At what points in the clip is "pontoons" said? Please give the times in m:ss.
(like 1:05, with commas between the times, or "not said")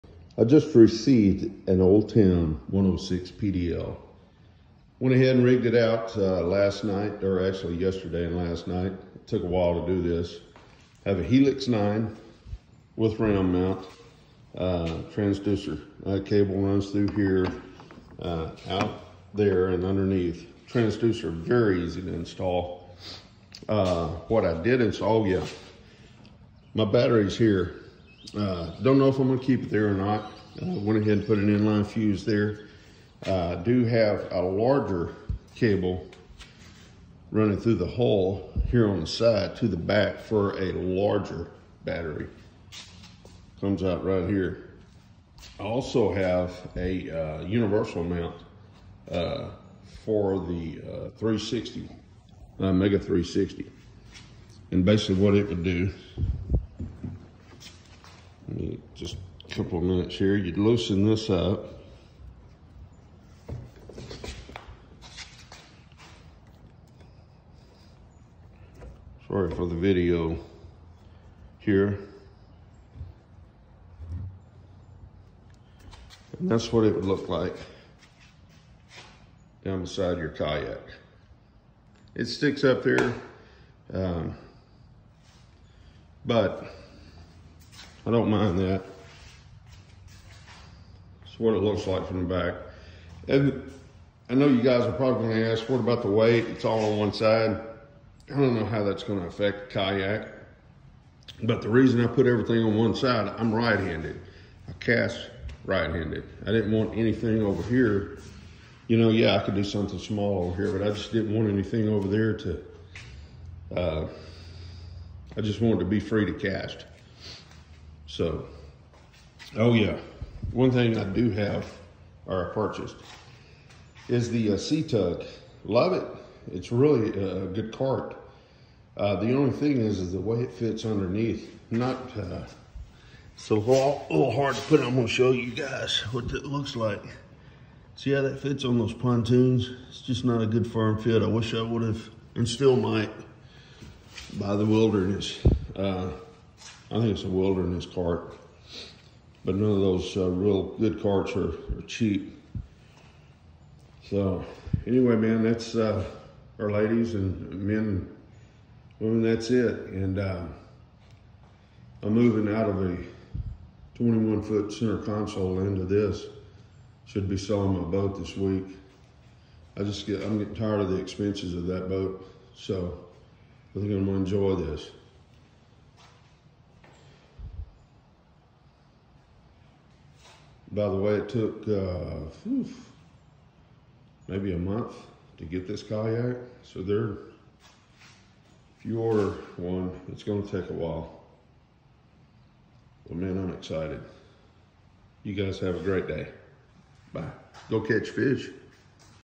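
2:18.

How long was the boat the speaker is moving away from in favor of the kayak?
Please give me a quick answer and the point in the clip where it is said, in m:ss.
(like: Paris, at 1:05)
21 foot, at 2:43.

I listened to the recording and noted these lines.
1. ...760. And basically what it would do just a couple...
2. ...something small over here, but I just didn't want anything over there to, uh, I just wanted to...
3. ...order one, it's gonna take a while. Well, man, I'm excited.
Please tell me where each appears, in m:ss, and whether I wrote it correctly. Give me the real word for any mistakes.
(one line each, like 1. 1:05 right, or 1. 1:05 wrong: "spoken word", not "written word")
1. 0:52 wrong: "360", not "760"
2. 1:49 right
3. 3:09 right.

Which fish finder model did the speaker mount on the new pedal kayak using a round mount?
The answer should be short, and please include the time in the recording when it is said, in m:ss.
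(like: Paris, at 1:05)
Helix 9, at 0:11.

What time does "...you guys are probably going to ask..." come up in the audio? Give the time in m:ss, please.
1:34.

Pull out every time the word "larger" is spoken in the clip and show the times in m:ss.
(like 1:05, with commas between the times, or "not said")
0:34, 0:40.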